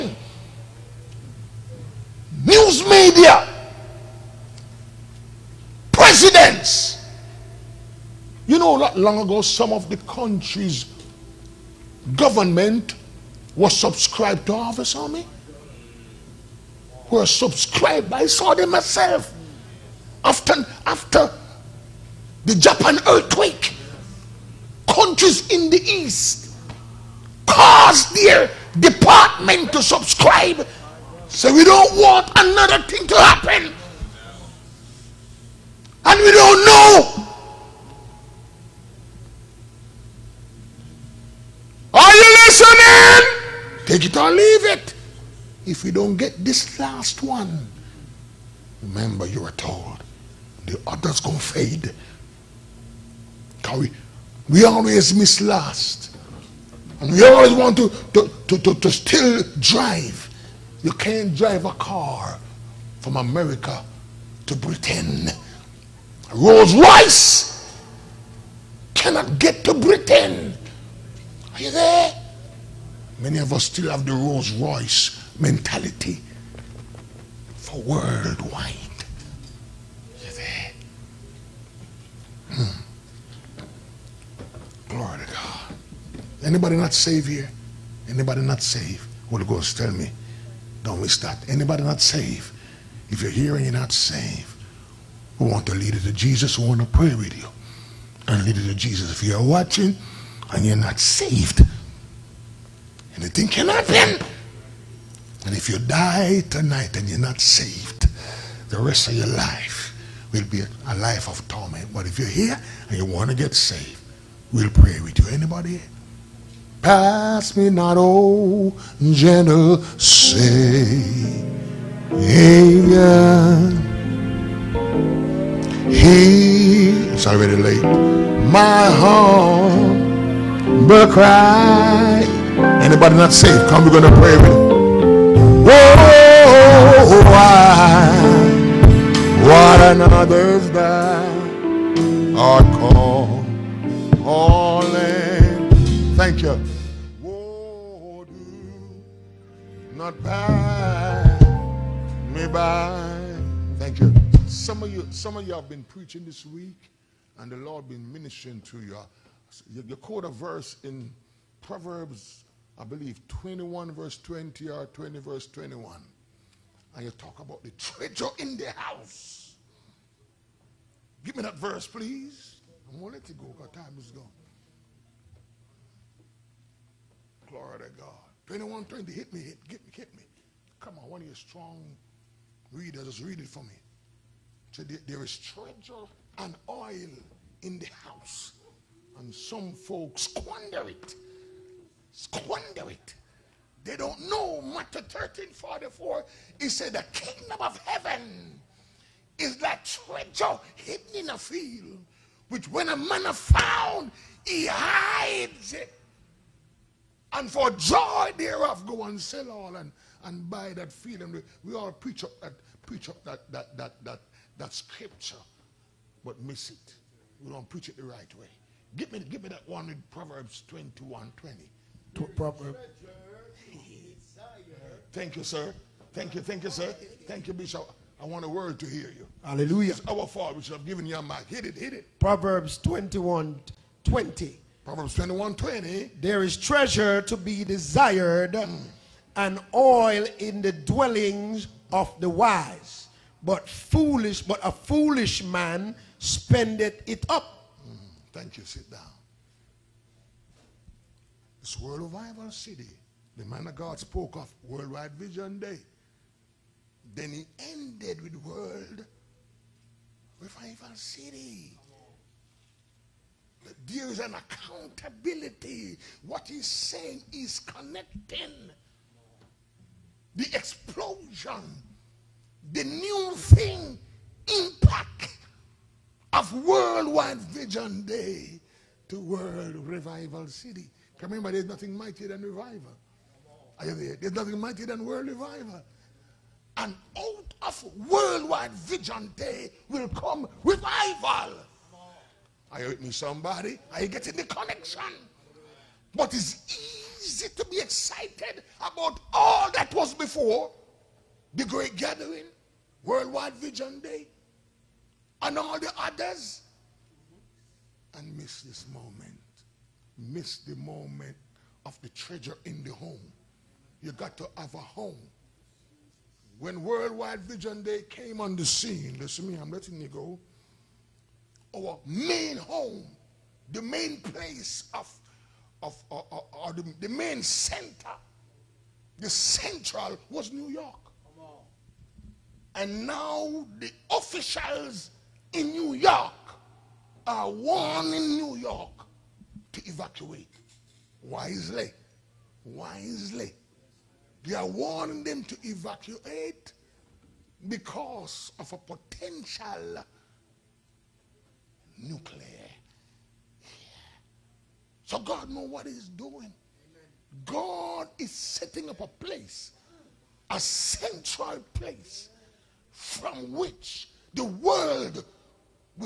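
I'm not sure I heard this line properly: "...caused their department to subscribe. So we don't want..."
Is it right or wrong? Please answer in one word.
right.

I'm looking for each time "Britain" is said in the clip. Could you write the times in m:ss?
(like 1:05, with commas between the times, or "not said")
1:04, 1:09.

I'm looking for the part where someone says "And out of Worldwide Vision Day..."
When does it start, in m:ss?
4:46.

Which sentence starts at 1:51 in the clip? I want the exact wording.
But if you're here and you want to get saved, we'll pray with you.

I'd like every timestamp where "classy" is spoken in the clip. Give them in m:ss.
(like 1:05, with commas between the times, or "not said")
not said.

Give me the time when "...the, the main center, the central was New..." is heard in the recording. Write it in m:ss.
5:26.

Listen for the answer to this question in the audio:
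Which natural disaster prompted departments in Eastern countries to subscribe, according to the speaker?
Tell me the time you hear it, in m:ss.
0:22.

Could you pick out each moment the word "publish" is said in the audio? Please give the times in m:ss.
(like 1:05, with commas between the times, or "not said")
not said.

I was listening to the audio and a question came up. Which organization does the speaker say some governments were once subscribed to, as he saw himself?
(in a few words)
Harvest Army.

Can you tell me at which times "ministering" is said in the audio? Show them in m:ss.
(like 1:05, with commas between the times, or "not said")
2:38.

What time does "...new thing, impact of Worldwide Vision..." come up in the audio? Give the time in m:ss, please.
4:32.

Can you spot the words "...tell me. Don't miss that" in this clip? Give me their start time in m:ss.
1:29.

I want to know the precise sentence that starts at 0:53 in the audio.
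Can we, we always miss last.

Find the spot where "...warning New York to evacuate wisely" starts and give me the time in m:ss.
5:37.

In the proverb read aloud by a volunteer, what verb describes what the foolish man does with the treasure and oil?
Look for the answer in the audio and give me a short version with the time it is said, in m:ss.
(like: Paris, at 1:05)
spendeth it up, at 4:06.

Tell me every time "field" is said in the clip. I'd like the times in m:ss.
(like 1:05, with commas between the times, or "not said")
3:21, 3:30.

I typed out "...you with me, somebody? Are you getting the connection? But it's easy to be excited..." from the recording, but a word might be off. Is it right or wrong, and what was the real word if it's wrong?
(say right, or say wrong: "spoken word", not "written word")
right.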